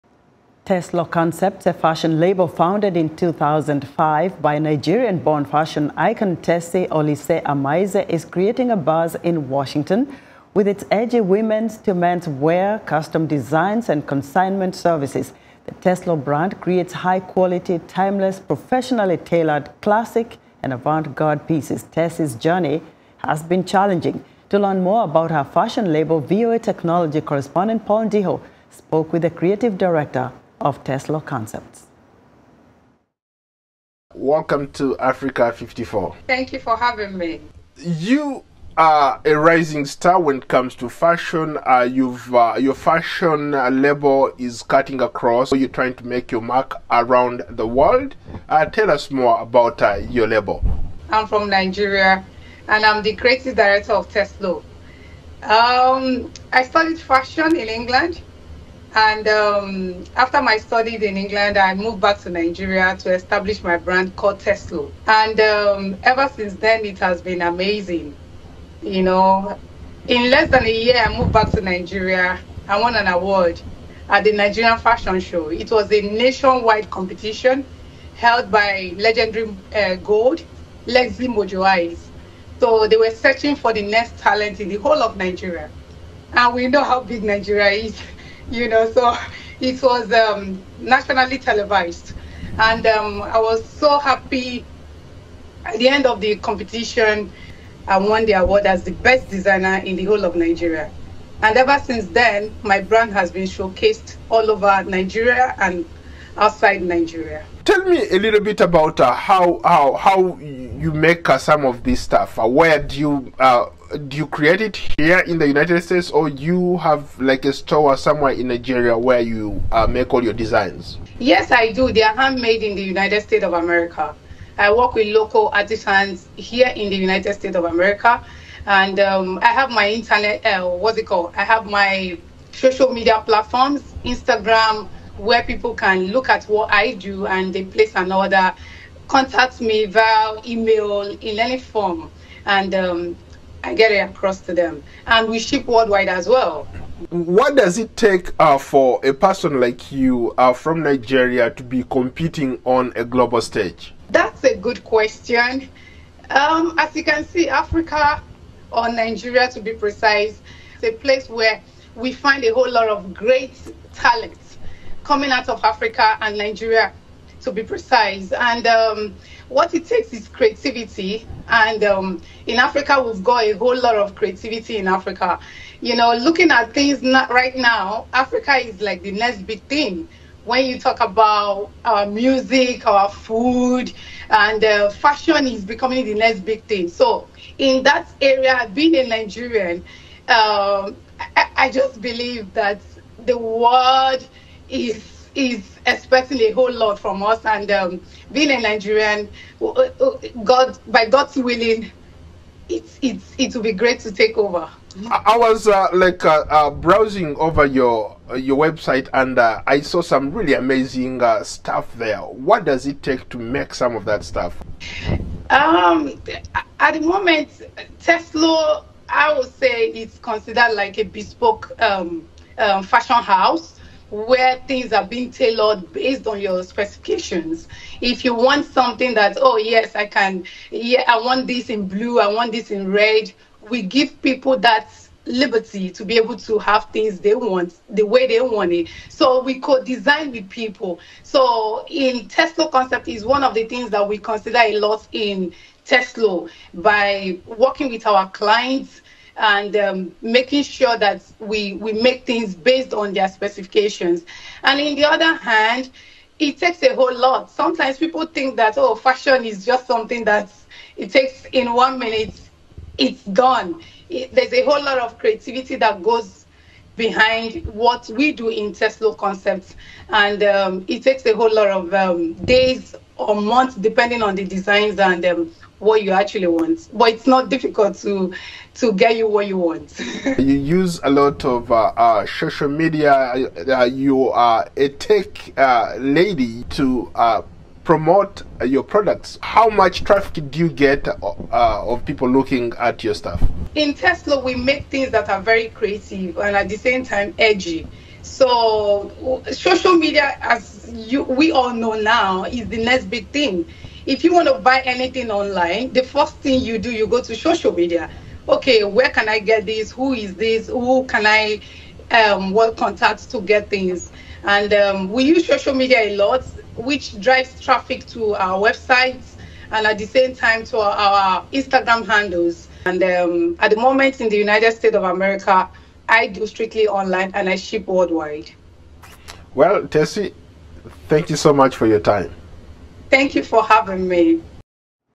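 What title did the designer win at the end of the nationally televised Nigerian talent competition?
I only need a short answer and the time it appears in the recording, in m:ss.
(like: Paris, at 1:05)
Best designer, at 1:38.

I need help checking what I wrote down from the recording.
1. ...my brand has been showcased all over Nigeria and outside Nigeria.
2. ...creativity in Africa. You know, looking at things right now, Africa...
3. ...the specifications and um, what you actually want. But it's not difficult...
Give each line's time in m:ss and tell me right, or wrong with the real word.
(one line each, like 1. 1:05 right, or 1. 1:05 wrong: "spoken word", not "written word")
1. 1:42 right
2. 2:54 right
3. 4:34 wrong: "designs", not "specifications".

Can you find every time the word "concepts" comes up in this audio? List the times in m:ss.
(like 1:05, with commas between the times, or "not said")
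0:01, 0:31, 4:02, 4:29.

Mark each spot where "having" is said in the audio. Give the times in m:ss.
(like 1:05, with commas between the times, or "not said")
0:36, 5:33.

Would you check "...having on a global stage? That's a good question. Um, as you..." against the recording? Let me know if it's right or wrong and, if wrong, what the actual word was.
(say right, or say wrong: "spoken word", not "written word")
wrong: "competing", not "having".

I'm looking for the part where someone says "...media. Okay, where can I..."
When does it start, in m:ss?
5:07.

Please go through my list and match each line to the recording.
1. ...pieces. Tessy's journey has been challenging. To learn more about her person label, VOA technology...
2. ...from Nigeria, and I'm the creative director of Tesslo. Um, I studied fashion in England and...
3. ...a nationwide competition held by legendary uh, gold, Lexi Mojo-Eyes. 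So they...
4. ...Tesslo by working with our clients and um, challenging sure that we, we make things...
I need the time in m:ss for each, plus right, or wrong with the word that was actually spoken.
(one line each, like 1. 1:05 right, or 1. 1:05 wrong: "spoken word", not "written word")
1. 0:21 wrong: "fashion", not "person"
2. 0:51 right
3. 1:15 right
4. 4:05 wrong: "making", not "challenging".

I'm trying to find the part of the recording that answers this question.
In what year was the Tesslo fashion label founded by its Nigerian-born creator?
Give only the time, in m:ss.
0:03.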